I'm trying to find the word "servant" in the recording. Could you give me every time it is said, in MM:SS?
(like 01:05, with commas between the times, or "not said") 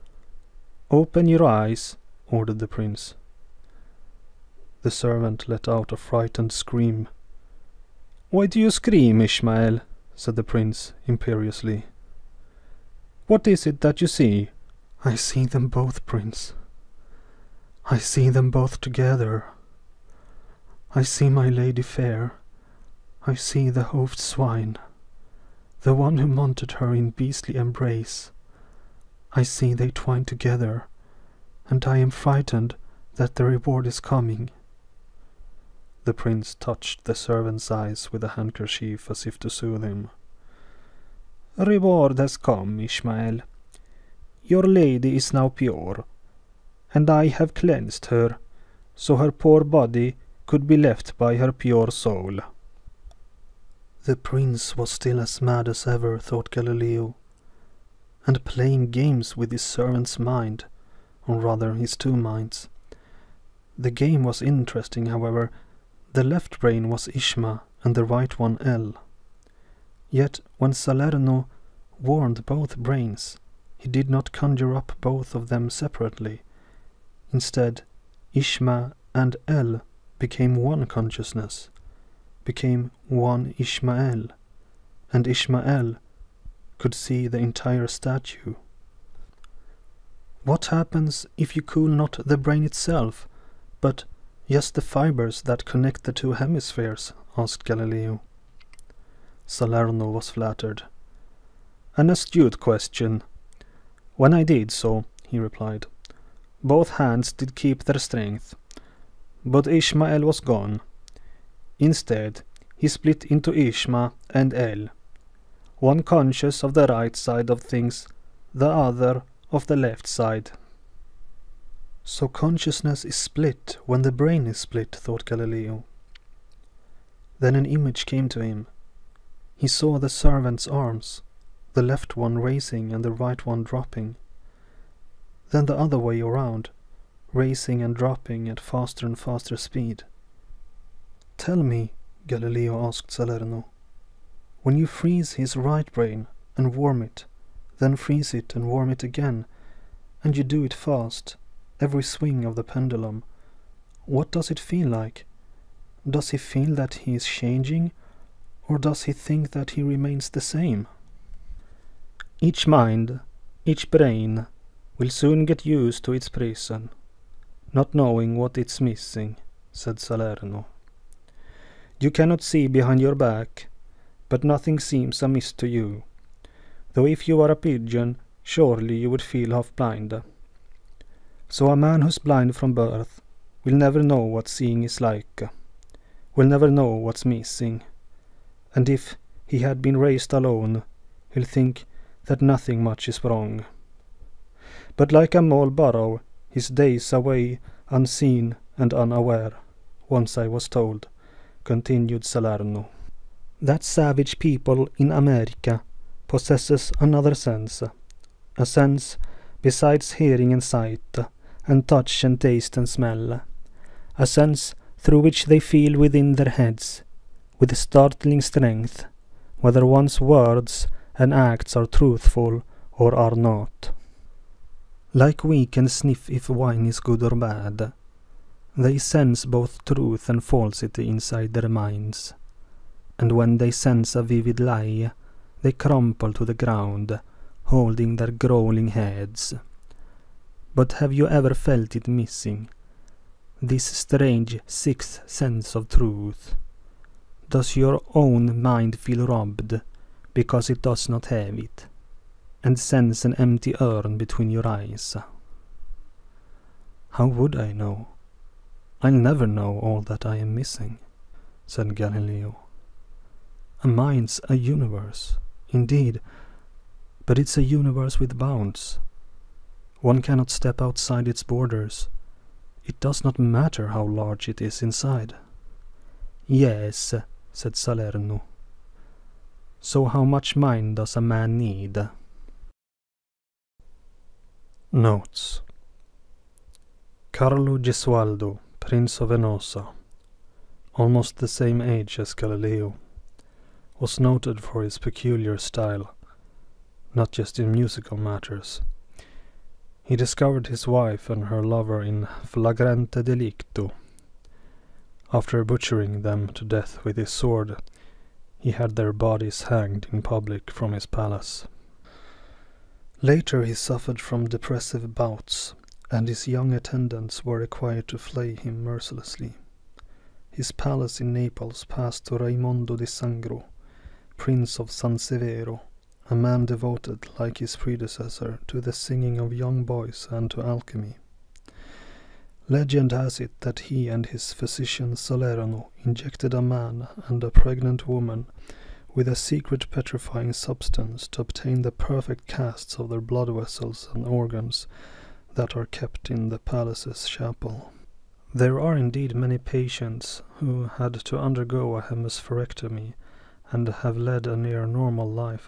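00:04, 00:37, 00:59, 02:10.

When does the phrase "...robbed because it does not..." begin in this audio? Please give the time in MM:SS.
04:09.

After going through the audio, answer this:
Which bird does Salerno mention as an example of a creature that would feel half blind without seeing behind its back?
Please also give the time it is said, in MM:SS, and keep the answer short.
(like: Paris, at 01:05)
pigeon, at 02:57.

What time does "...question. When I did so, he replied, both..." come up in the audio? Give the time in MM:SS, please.
01:42.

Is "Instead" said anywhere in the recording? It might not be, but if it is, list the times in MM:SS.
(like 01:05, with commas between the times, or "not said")
01:17, 01:51.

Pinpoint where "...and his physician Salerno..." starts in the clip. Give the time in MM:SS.
05:34.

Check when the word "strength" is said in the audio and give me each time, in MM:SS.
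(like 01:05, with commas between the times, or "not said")
01:47, 03:38.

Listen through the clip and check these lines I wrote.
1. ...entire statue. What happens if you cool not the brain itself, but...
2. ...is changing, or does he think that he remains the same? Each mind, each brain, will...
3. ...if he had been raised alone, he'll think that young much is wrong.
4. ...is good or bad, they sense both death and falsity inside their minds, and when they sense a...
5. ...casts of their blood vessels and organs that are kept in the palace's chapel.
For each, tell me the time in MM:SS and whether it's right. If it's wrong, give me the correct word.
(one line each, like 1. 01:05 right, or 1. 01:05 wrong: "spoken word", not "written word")
1. 01:27 right
2. 02:37 right
3. 03:08 wrong: "nothing", not "young"
4. 03:46 wrong: "truth", not "death"
5. 05:42 right.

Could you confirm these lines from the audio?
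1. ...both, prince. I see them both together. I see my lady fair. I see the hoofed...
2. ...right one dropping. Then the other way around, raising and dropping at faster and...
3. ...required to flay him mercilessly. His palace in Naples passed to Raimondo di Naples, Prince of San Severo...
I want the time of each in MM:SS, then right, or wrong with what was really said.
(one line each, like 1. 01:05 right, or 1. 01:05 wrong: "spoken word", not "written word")
1. 00:15 right
2. 02:13 right
3. 05:17 wrong: "Sangro", not "Naples".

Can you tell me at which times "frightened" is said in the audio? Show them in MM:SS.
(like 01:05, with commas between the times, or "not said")
00:05, 00:32.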